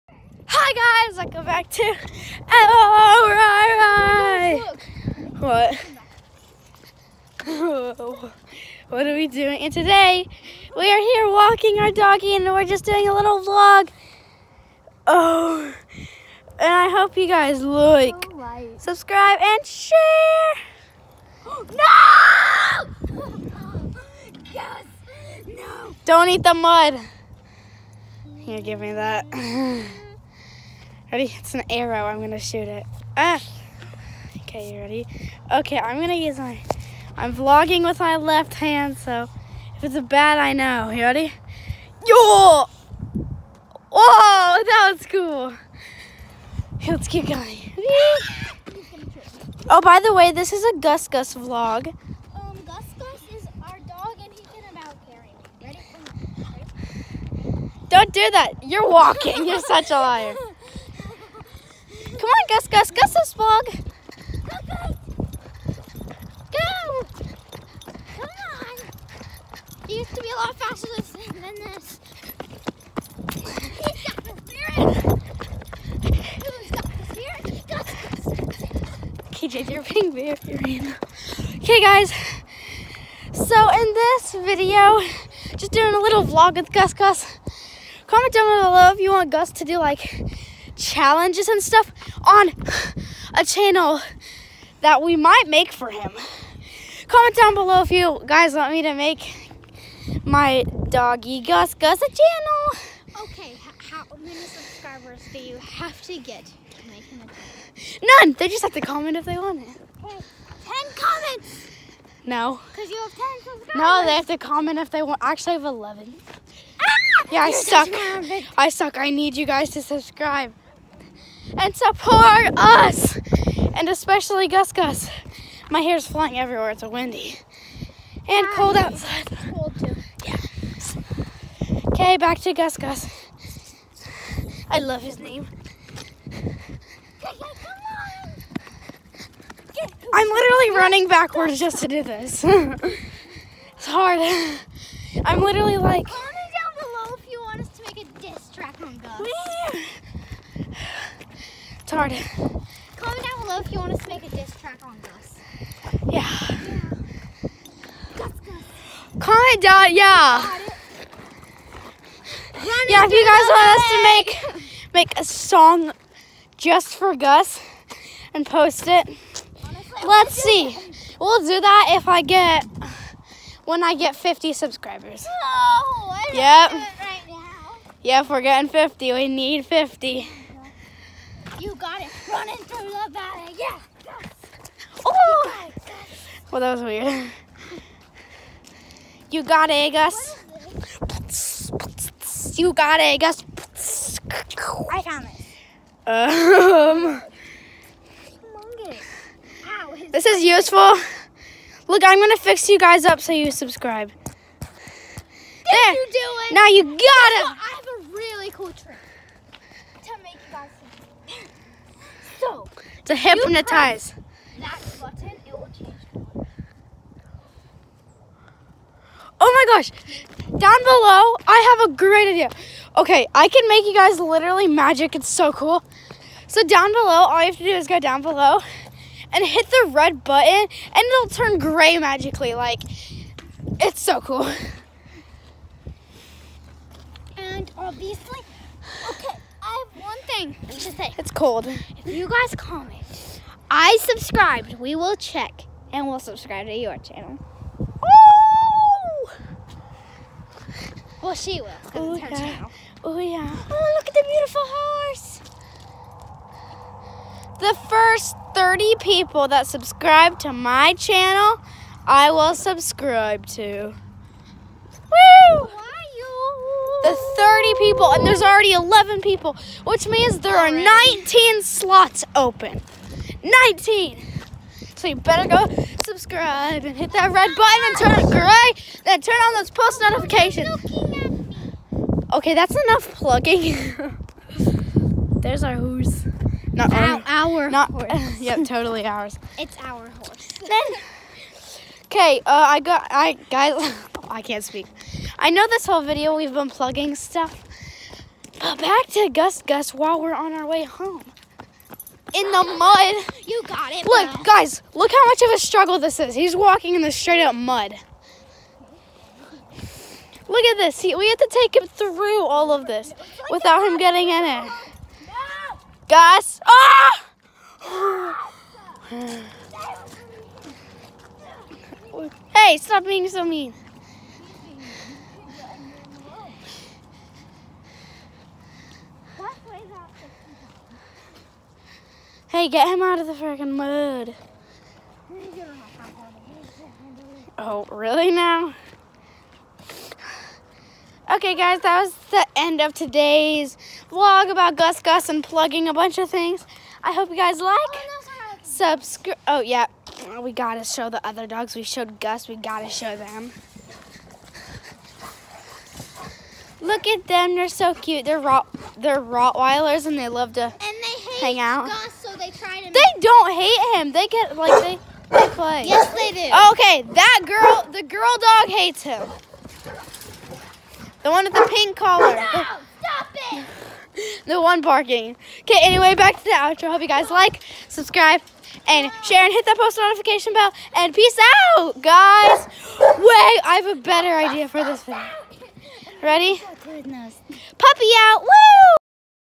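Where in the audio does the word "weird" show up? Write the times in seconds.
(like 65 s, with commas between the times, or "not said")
186 s.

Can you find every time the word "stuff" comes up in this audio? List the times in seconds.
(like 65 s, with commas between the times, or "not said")
91 s, 297 s.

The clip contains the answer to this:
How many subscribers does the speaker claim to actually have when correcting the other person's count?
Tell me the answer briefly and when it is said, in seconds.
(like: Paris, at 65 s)
11, at 115 s.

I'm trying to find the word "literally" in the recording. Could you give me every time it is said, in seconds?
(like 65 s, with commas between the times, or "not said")
140 s, 145 s, 224 s.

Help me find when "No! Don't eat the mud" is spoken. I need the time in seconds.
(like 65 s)
25 s.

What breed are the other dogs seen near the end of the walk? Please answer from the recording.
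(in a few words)
Rottweilers.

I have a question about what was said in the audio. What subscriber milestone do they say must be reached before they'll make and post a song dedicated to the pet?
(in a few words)
50.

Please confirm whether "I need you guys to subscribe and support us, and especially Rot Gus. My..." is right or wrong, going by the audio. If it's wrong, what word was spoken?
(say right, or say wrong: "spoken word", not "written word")
wrong: "Gus", not "Rot".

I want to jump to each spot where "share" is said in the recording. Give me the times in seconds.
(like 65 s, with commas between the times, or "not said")
19 s, 379 s.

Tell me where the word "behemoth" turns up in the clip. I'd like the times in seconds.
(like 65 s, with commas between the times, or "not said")
not said.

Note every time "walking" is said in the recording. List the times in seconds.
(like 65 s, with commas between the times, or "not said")
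11 s, 58 s, 306 s.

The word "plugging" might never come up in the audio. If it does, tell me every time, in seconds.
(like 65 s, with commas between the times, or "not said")
283 s, 296 s, 345 s.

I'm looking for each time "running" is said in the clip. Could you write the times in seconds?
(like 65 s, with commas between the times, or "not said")
140 s, 182 s.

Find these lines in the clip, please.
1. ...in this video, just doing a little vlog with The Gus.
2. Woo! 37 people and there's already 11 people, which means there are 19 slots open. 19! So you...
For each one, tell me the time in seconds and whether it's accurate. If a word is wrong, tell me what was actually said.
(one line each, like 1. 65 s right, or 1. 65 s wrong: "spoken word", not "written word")
1. 83 s wrong: "Gus", not "The"
2. 265 s wrong: "30", not "37".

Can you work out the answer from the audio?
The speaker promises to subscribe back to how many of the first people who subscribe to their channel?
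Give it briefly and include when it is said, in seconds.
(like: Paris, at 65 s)
30, at 257 s.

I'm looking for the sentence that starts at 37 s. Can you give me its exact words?
I'm vlogging with my left hand, so if it's a bat, I know.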